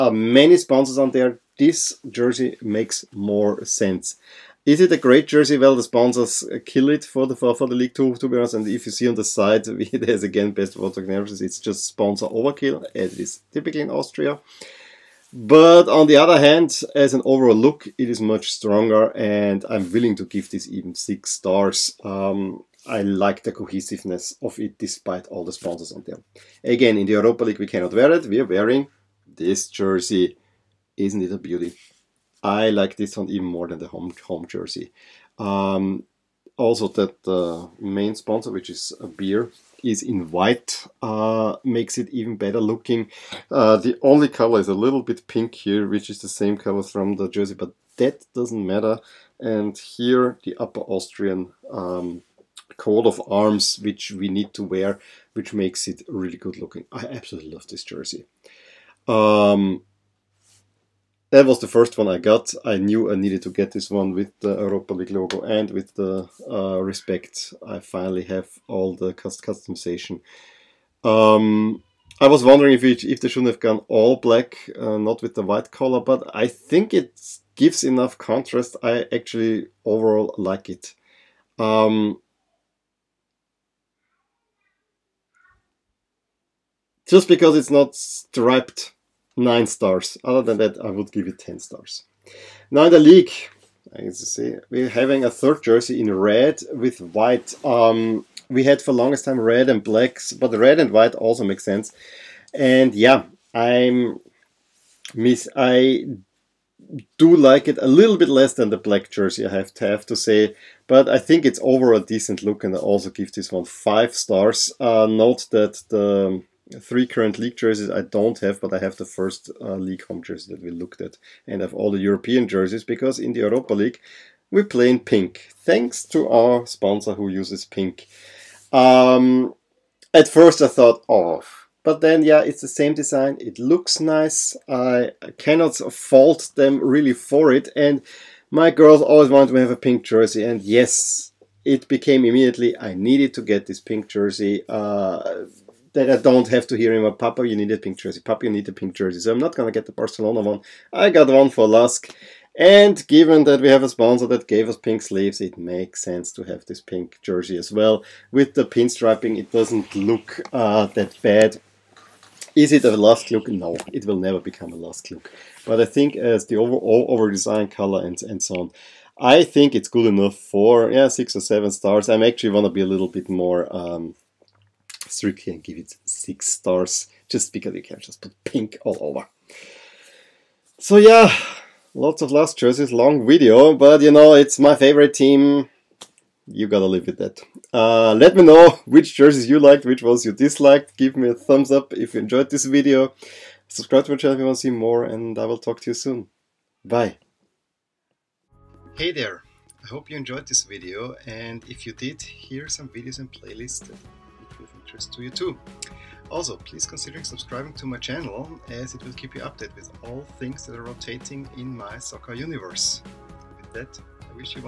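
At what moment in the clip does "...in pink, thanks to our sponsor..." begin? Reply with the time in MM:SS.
02:04.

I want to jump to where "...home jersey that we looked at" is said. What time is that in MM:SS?
02:00.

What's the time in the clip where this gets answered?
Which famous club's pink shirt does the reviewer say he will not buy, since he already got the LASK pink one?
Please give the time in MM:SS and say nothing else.
02:29.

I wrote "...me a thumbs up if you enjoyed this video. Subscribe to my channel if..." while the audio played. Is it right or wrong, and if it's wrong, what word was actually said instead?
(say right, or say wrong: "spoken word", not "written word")
right.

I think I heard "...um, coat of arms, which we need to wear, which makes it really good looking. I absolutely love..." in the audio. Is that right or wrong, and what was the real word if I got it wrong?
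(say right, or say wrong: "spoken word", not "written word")
right.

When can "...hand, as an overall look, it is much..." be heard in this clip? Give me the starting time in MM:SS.
00:16.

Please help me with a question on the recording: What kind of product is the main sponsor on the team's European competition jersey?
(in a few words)
Beer.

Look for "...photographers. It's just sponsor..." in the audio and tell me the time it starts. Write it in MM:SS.
00:10.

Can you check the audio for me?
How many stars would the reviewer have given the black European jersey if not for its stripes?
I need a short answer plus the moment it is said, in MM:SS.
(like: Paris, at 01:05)
10, at 01:31.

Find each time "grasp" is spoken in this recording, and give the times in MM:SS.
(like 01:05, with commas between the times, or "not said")
not said.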